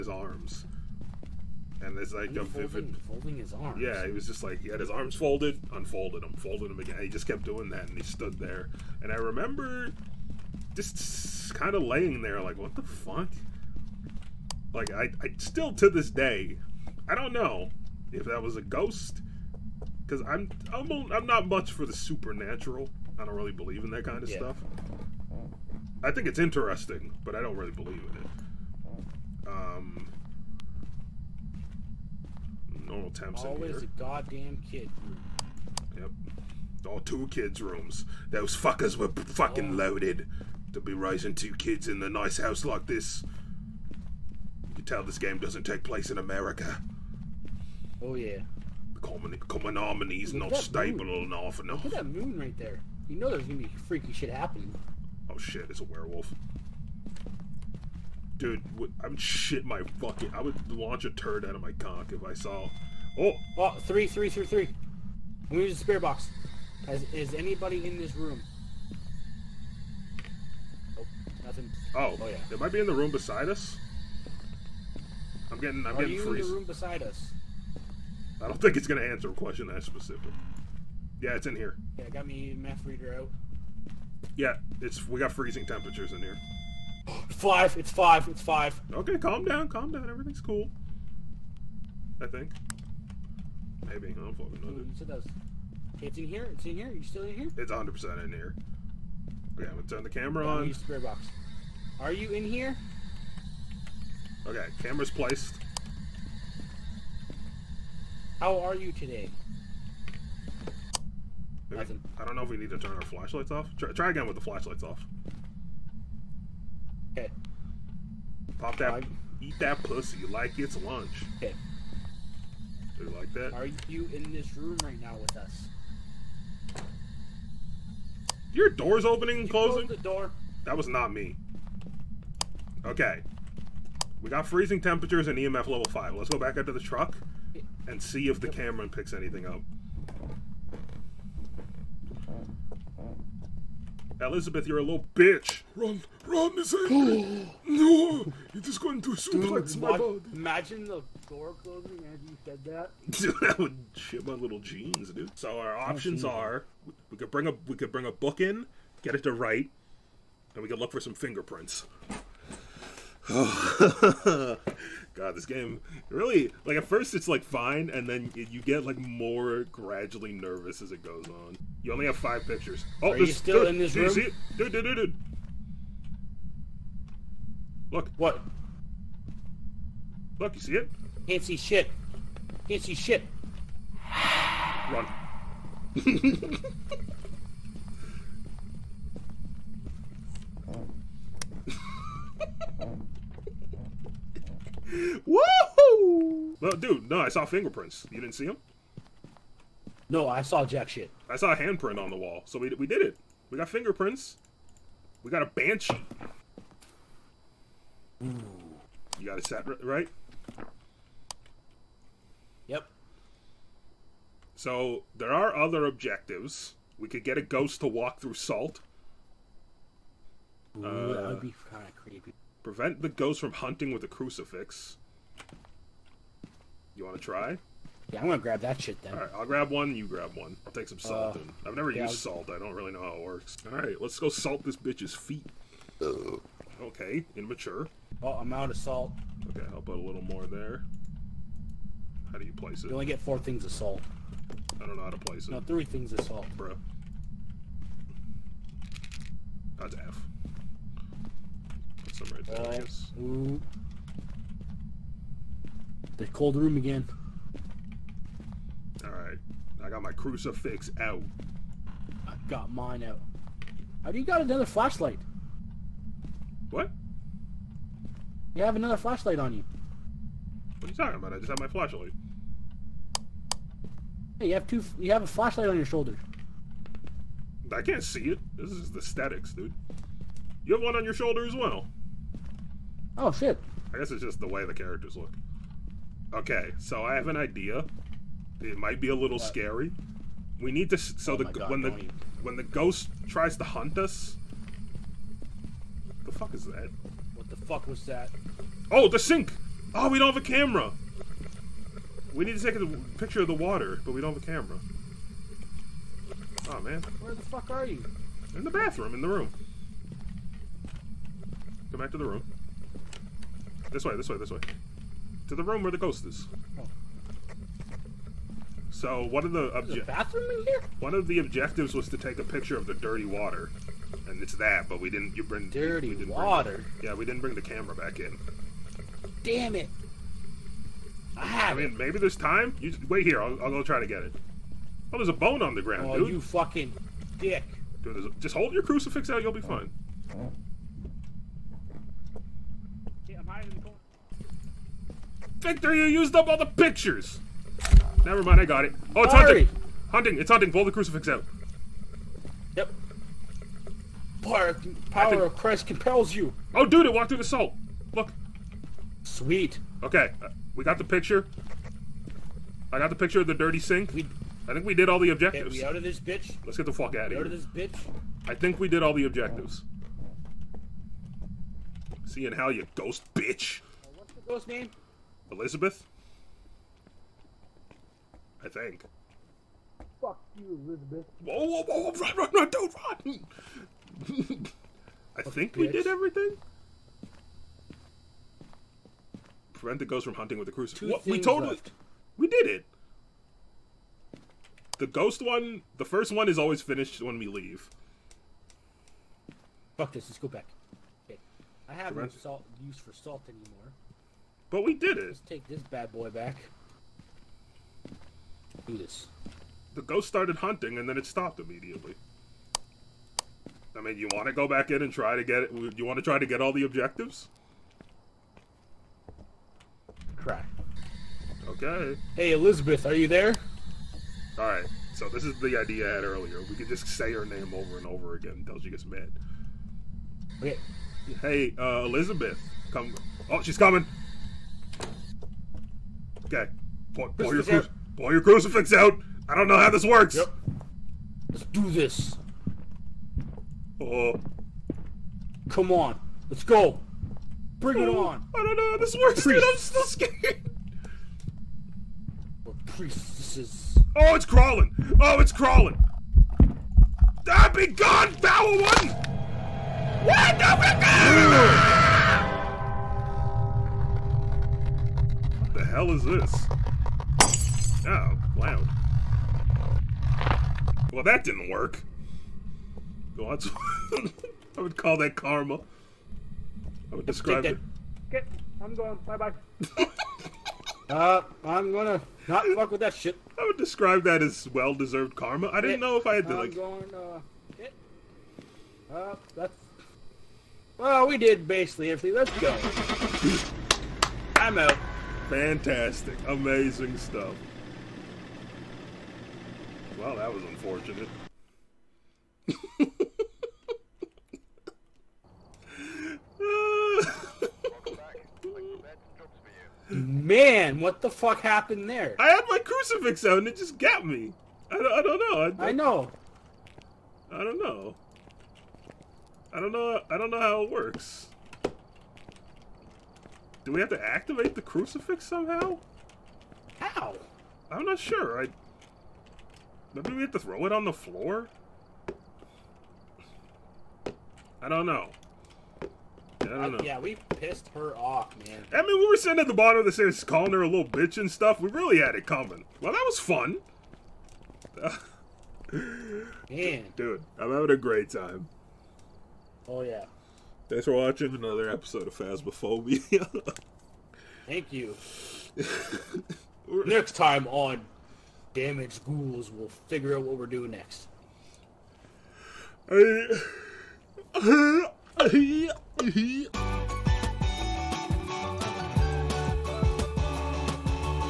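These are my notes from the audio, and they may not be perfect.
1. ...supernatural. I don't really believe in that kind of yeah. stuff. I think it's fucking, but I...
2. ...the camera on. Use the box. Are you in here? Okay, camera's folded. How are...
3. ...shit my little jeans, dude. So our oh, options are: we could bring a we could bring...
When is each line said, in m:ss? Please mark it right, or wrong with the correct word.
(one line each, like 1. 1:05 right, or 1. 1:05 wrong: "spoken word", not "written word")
1. 0:21 wrong: "interesting", not "fucking"
2. 1:40 wrong: "placed", not "folded"
3. 2:33 right.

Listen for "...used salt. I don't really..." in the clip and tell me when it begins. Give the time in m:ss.
3:52.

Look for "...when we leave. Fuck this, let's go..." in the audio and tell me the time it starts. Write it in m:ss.
6:37.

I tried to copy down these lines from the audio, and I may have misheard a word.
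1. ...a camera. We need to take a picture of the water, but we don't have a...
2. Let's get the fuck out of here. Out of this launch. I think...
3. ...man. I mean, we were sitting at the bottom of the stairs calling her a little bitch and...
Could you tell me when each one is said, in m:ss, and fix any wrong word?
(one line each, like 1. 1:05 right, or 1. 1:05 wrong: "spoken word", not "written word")
1. 5:00 right
2. 6:06 wrong: "bitch", not "launch"
3. 8:58 right.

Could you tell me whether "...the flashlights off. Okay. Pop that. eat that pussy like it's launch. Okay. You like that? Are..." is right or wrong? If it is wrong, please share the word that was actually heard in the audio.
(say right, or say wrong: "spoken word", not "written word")
wrong: "lunch", not "launch".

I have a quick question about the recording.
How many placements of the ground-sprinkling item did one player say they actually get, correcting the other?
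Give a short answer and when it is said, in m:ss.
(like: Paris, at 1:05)
3, at 4:05.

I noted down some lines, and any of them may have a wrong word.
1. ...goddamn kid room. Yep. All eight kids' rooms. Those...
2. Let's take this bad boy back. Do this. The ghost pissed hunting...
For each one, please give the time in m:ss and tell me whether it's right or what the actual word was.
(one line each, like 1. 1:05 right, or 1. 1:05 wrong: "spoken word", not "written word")
1. 0:33 wrong: "two", not "eight"
2. 6:45 wrong: "started", not "pissed".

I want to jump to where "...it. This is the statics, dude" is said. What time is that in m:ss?
4:38.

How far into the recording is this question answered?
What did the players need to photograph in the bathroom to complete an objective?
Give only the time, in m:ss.
5:22.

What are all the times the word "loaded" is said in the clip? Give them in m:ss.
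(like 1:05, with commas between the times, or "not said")
0:39.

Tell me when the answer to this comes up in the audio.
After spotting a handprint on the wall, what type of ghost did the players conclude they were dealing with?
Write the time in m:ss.
3:25.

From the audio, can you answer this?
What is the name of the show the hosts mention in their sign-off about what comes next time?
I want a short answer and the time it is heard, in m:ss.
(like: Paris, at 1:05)
Damaged Ghouls, at 9:18.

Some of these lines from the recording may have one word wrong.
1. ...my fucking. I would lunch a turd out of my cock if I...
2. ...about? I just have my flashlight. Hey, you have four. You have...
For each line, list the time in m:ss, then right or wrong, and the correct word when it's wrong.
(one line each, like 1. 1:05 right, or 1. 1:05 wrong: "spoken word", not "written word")
1. 0:59 wrong: "launch", not "lunch"
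2. 4:31 wrong: "two", not "four".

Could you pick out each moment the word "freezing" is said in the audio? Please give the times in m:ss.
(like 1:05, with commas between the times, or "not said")
1:25, 2:14.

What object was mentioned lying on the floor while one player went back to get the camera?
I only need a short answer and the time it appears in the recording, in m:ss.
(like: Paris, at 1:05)
A bone, at 5:35.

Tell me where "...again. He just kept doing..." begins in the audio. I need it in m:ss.
0:06.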